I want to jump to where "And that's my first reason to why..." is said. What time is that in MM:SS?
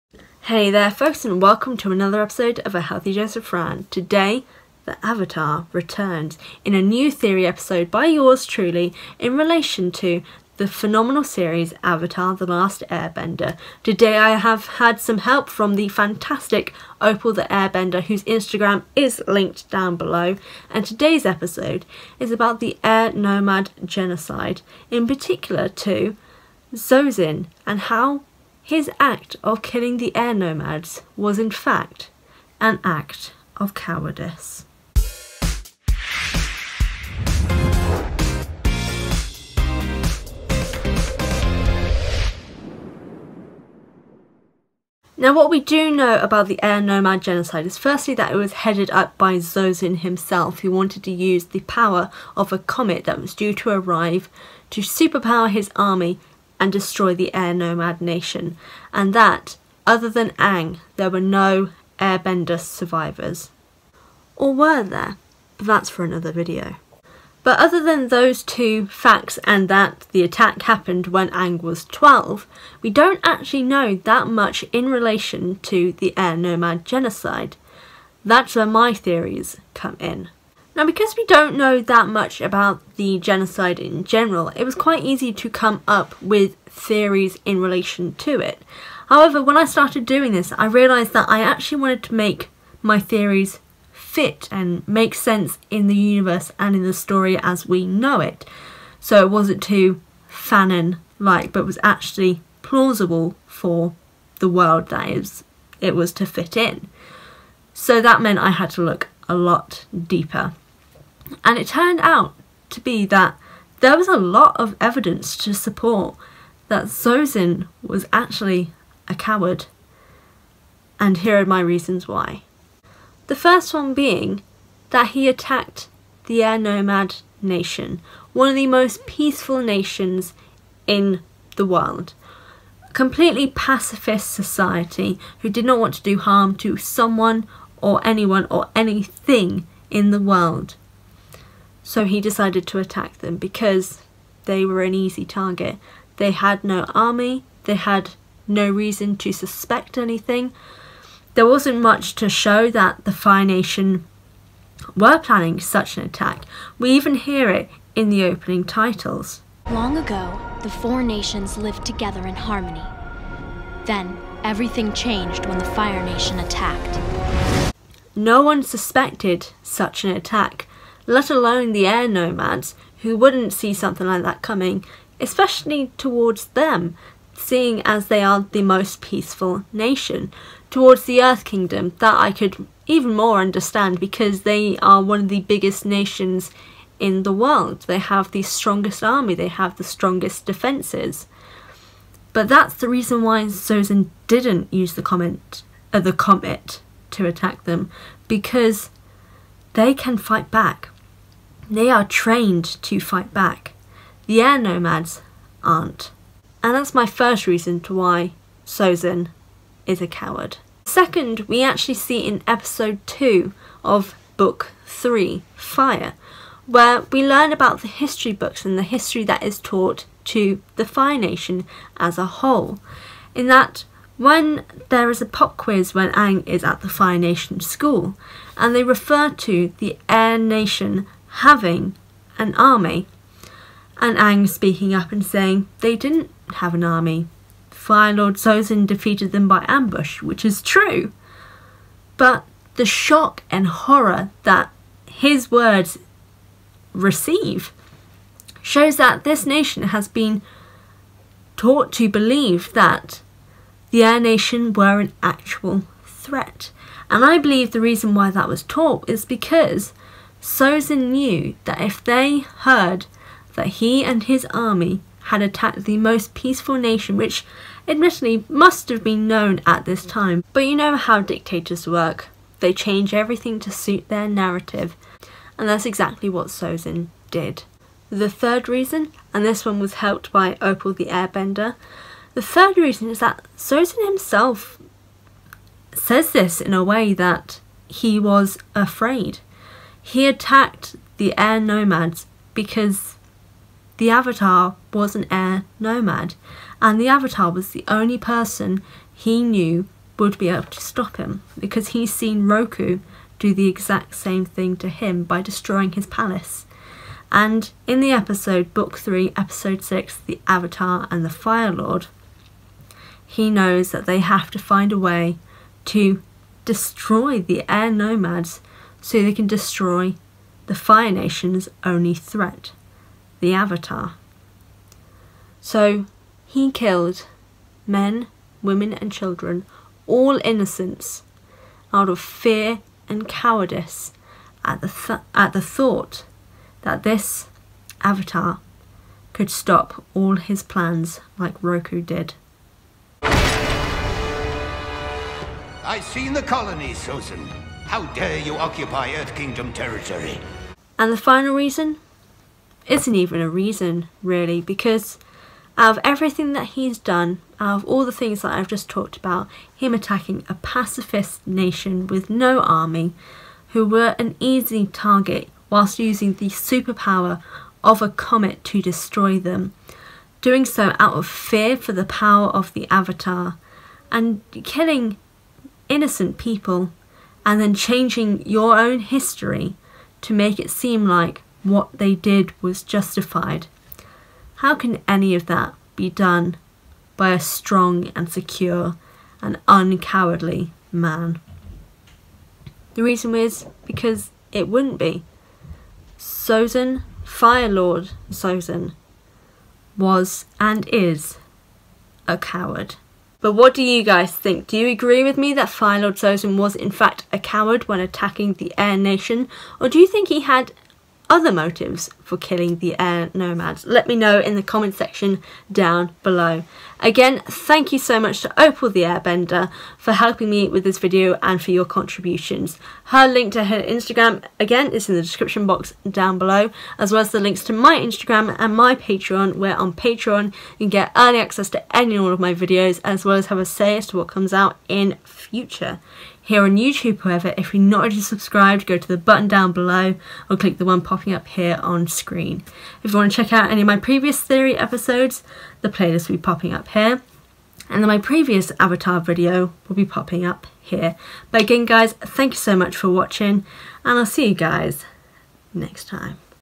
03:26.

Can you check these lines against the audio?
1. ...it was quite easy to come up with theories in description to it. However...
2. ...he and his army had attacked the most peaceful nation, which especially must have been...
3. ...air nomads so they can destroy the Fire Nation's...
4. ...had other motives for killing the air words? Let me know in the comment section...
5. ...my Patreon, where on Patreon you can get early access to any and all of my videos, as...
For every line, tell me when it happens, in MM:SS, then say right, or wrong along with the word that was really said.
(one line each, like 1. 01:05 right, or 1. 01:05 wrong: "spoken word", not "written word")
1. 01:24 wrong: "relation", not "description"
2. 04:23 wrong: "admittedly", not "especially"
3. 05:17 right
4. 06:50 wrong: "nomads", not "words"
5. 07:08 right.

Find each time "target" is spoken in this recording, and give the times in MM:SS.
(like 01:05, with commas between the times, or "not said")
02:25, 06:04.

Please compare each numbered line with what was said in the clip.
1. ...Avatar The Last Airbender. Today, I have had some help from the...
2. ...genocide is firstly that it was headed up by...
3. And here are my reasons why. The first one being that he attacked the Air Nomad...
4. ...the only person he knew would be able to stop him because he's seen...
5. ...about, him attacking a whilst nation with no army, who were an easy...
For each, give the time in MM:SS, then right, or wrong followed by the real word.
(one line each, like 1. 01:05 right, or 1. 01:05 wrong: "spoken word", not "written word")
1. 00:11 right
2. 00:47 right
3. 02:00 right
4. 04:57 right
5. 05:59 wrong: "pacifist", not "whilst".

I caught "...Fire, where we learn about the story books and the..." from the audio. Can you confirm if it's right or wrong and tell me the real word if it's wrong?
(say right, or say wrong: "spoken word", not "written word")
wrong: "history", not "story".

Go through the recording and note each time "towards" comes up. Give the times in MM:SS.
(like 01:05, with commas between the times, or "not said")
02:55, 03:00.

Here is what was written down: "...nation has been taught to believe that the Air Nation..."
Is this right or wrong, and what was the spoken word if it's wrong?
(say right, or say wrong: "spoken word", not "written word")
right.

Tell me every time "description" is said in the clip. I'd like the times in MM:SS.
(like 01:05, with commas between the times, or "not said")
07:05.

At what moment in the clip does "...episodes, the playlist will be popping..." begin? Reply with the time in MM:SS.
07:24.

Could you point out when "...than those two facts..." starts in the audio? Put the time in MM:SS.
01:07.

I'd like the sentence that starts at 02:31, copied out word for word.
There wasn't much to show that the Fire Nation were planning such an attack.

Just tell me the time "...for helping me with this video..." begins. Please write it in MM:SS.
06:59.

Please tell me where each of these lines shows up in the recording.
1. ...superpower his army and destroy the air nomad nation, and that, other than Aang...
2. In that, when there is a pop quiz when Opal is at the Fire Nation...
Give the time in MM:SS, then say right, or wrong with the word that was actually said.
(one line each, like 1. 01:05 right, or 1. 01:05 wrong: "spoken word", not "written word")
1. 00:54 right
2. 03:43 wrong: "Aang", not "Opal".